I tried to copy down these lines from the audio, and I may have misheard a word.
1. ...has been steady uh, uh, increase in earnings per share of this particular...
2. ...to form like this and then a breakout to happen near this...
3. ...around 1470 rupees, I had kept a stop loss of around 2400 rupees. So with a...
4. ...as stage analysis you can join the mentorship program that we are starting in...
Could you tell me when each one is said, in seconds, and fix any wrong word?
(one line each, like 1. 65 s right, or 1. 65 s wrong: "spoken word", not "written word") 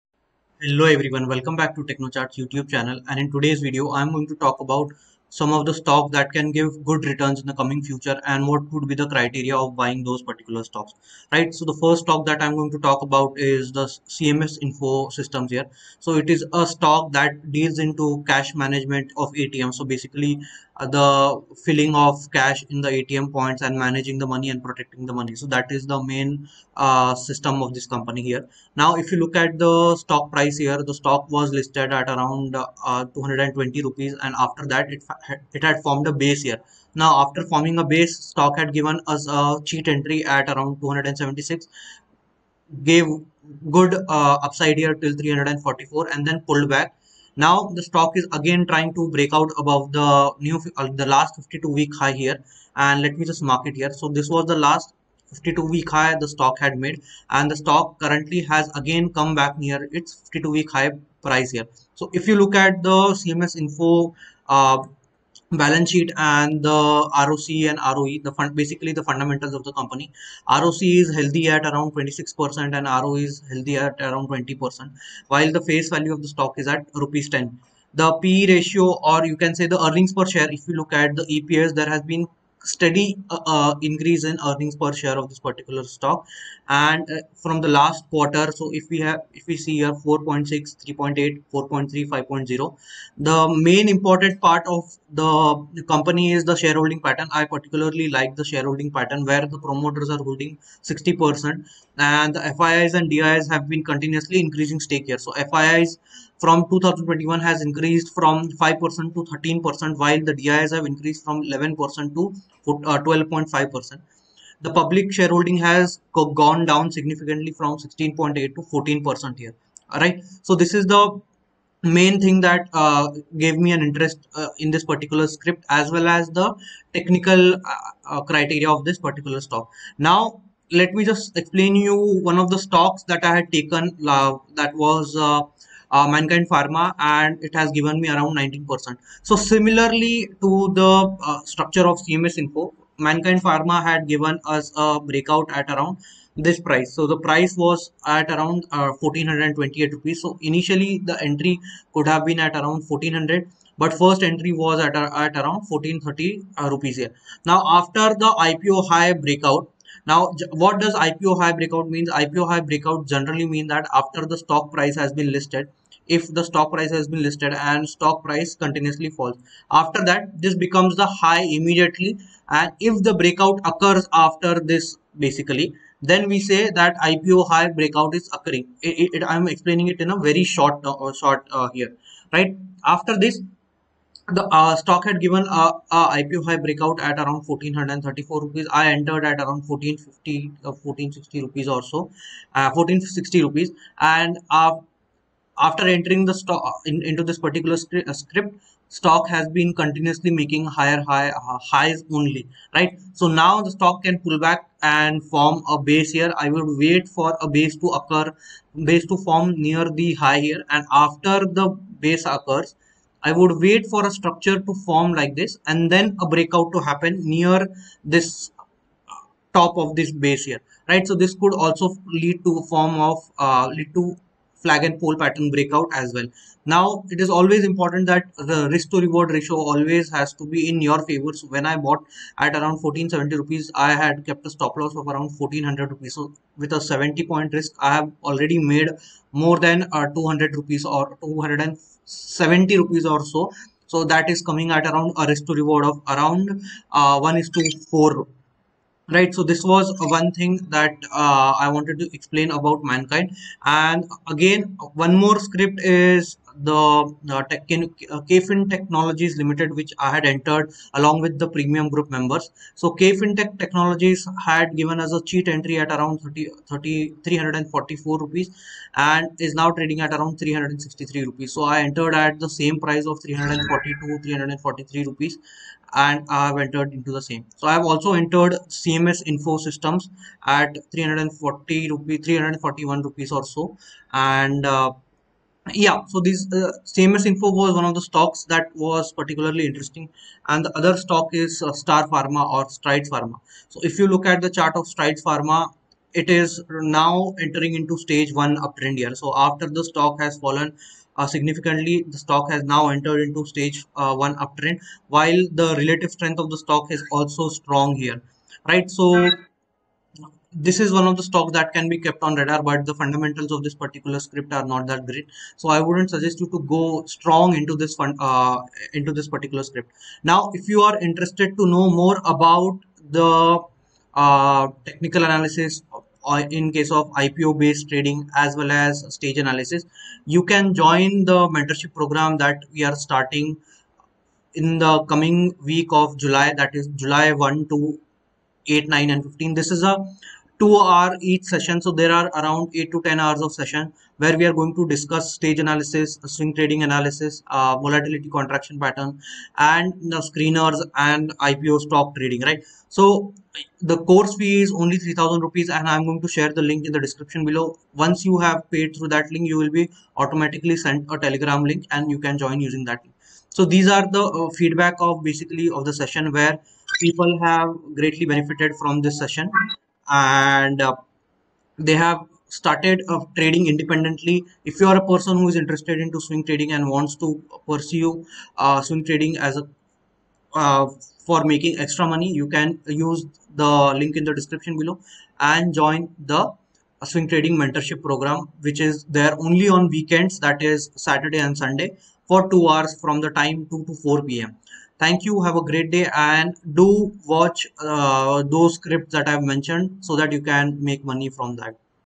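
1. 81 s right
2. 214 s right
3. 232 s wrong: "1400", not "2400"
4. 328 s right.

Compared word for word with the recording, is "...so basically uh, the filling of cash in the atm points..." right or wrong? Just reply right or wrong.
right.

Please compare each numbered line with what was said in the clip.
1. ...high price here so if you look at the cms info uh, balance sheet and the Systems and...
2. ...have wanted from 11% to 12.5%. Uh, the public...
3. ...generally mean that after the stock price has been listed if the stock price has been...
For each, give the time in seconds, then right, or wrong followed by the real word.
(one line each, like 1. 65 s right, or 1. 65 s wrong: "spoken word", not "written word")
1. 60 s wrong: "ROC", not "Systems"
2. 110 s wrong: "increased", not "wanted"
3. 163 s right.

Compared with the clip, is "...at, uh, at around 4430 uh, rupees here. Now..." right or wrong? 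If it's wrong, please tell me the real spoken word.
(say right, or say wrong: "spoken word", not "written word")
wrong: "1430", not "4430".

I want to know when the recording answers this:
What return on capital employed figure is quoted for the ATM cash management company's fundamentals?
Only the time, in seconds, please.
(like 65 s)
71 s.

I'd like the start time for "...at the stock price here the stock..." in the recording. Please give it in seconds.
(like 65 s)
29 s.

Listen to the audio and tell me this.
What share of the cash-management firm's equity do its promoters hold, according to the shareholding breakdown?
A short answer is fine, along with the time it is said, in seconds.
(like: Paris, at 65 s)
60 percent, at 100 s.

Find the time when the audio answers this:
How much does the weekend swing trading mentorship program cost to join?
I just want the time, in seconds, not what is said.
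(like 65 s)
355 s.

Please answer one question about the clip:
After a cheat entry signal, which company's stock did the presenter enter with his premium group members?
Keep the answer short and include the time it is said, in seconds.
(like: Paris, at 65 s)
KFin Technologies, at 258 s.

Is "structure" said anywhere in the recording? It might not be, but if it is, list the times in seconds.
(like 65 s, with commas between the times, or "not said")
141 s, 214 s.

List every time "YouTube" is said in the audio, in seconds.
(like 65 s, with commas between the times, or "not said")
2 s.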